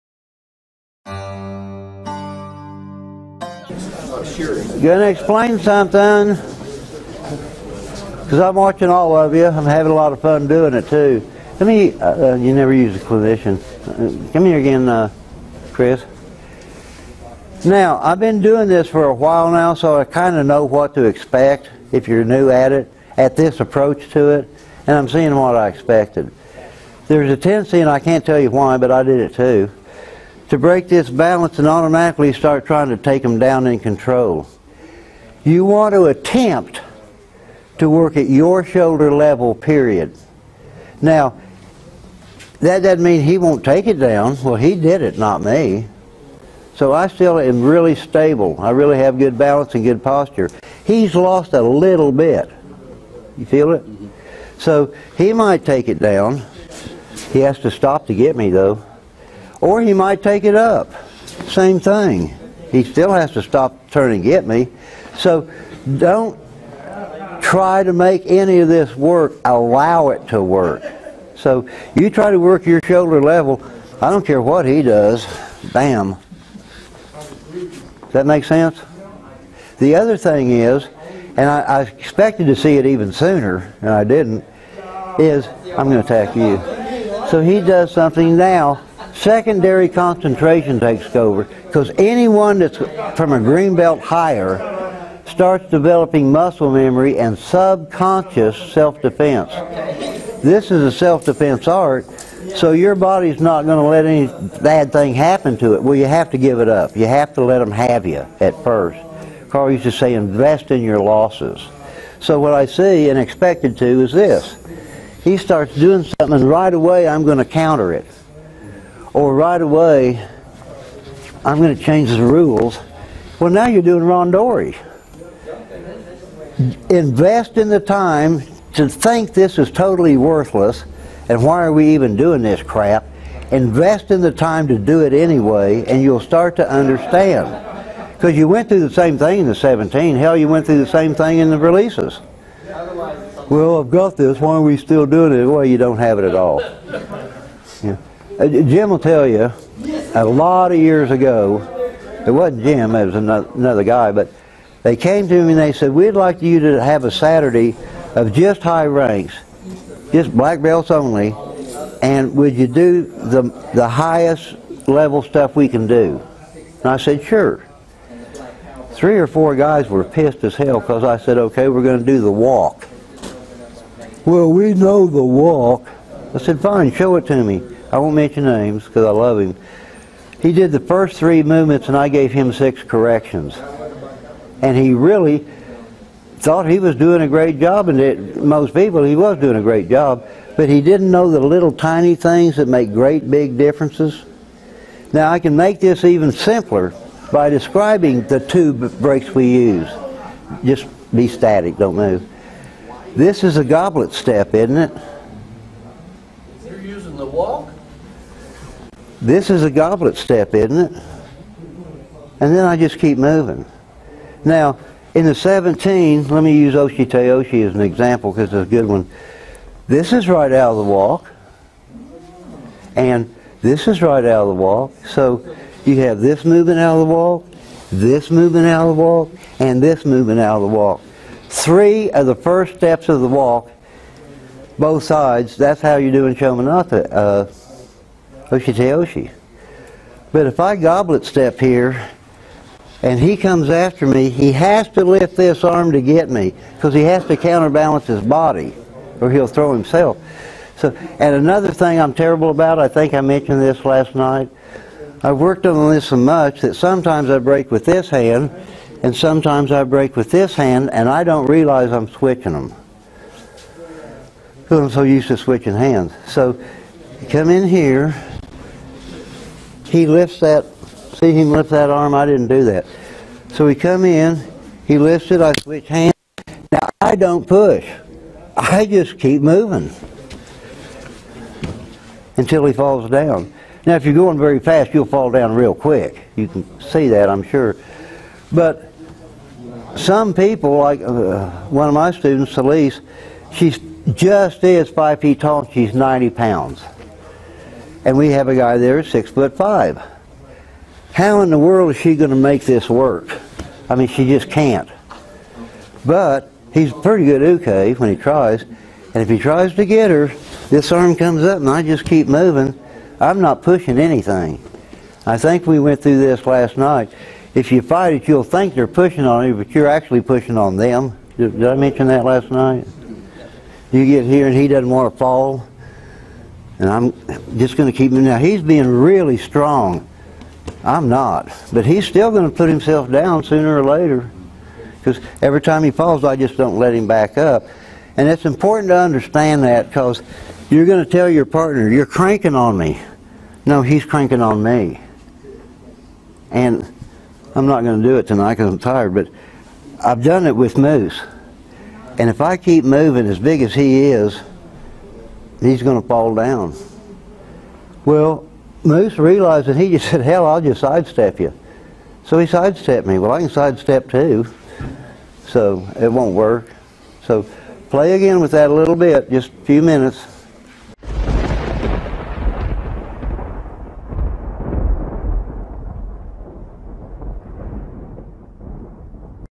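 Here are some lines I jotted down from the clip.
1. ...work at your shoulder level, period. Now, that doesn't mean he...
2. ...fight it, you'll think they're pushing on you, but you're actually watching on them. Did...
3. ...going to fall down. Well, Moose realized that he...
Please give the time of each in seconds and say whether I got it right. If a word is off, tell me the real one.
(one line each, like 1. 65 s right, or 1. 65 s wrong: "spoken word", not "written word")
1. 37 s right
2. 317 s wrong: "pushing", not "watching"
3. 355 s right.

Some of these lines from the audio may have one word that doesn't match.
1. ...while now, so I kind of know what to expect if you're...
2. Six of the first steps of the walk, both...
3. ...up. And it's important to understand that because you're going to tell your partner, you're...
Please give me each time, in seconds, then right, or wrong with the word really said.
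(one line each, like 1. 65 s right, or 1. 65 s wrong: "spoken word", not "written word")
1. 19 s right
2. 231 s wrong: "Three", not "Six"
3. 337 s right.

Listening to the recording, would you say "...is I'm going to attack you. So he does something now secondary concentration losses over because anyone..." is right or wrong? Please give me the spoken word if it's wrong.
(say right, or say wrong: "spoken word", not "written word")
wrong: "takes", not "losses".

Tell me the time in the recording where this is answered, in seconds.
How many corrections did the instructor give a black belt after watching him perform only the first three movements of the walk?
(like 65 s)
182 s.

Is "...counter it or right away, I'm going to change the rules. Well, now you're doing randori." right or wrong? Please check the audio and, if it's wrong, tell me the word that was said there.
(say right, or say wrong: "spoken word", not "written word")
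right.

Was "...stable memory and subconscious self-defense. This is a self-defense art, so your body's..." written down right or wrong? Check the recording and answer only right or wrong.
wrong.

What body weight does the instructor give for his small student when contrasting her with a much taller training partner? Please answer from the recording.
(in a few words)
90 pounds.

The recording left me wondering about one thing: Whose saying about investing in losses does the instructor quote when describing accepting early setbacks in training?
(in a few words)
Karl.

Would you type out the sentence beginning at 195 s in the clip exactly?
Now I can make this even simpler by describing the two breaks we use.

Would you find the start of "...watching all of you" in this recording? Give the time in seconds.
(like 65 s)
8 s.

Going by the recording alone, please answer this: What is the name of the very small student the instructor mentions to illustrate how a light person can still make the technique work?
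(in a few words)
Elise.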